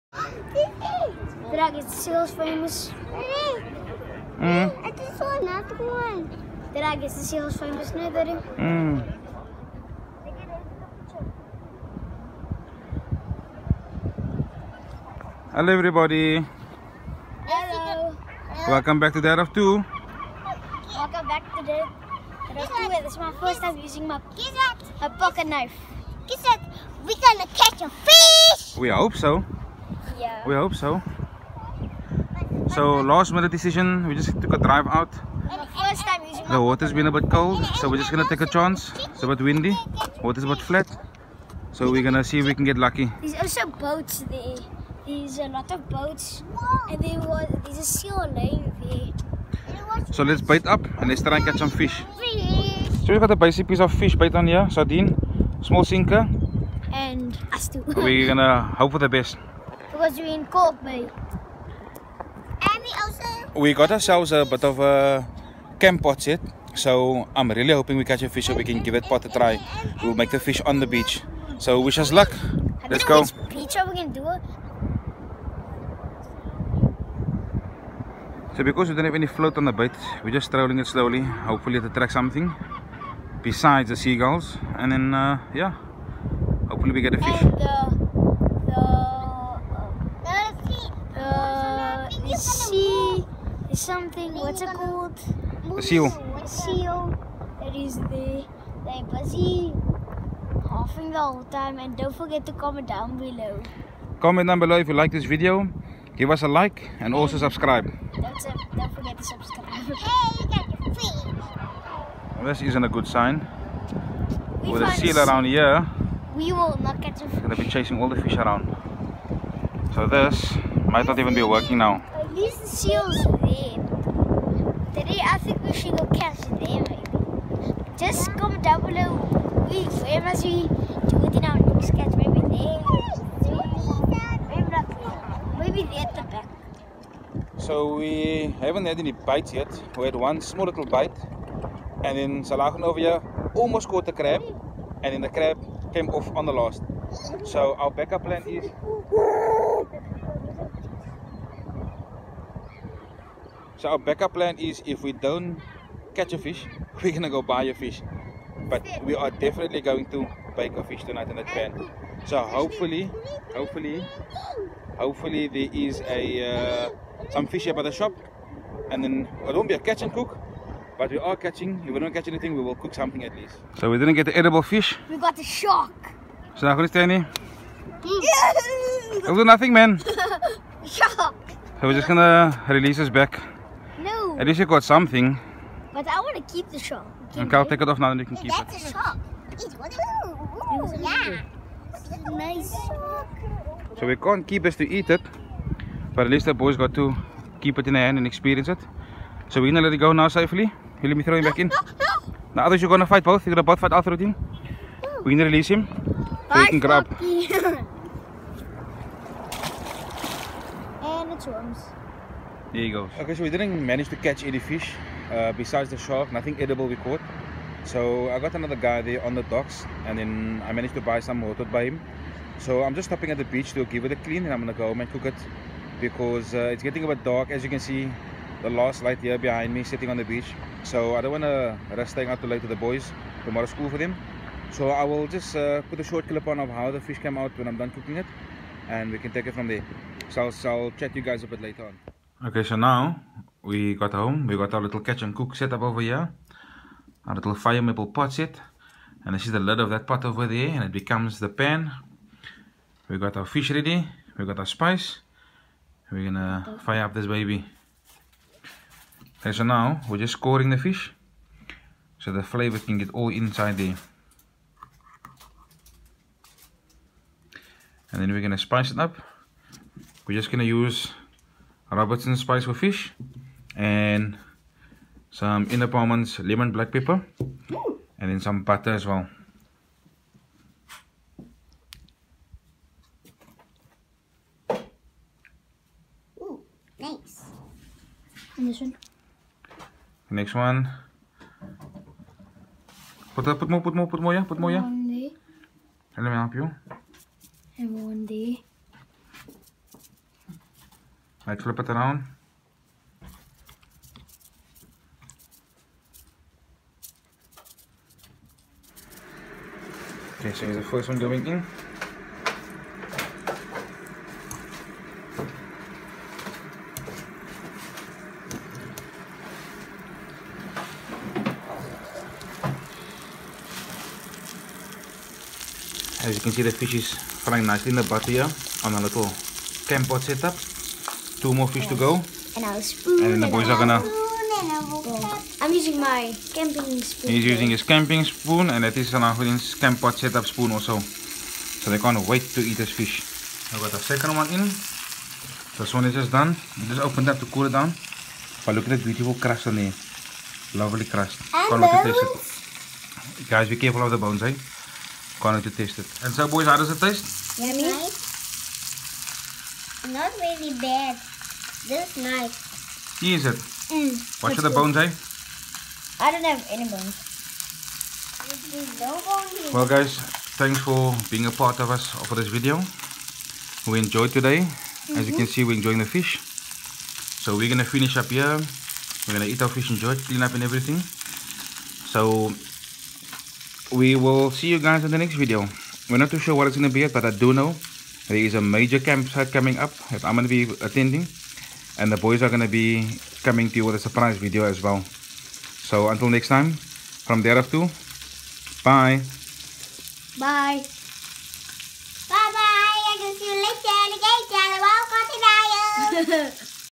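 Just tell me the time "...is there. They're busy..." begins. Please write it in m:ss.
1:37.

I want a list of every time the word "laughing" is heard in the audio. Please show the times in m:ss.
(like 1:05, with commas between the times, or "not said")
1:40.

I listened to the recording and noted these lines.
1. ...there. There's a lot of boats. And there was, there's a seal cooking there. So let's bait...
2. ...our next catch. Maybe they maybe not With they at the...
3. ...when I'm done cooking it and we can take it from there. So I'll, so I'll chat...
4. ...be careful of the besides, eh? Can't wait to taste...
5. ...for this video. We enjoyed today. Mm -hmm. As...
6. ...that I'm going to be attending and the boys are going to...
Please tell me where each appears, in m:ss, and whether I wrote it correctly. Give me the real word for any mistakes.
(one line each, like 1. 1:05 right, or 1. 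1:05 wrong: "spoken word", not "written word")
1. 0:44 wrong: "laying", not "cooking"
2. 2:11 wrong: "Maybe", not "With"
3. 3:57 right
4. 5:53 wrong: "bones", not "besides"
5. 6:12 right
6. 6:30 right.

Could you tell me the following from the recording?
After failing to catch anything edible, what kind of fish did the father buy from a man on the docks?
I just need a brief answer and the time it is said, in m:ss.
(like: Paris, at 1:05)
Rotot, at 3:41.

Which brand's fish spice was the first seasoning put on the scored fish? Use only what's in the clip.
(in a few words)
Robertson.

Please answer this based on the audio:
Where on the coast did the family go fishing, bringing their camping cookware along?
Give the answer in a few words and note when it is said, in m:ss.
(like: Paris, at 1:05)
Kalk Bay, at 1:00.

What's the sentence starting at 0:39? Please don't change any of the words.
It's a bit windy, water's a bit flat.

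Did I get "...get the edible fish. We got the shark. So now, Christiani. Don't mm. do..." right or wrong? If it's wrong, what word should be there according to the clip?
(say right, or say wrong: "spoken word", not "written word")
right.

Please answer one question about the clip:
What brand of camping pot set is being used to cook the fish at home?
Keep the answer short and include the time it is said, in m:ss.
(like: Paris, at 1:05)
Fire Maple, at 4:07.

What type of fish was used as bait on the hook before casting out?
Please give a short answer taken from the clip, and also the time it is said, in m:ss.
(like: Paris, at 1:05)
Sardine, at 0:54.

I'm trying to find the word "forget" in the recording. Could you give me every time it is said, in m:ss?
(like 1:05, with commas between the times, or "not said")
1:42, 1:48.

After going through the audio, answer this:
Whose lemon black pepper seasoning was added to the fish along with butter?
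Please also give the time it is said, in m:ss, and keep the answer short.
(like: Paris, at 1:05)
Ina Paarman's, at 4:35.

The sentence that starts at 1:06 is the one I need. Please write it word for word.
So I'm really hoping we catch a fish so we can give it pot a try.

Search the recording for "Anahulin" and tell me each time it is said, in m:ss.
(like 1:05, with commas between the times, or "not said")
5:39.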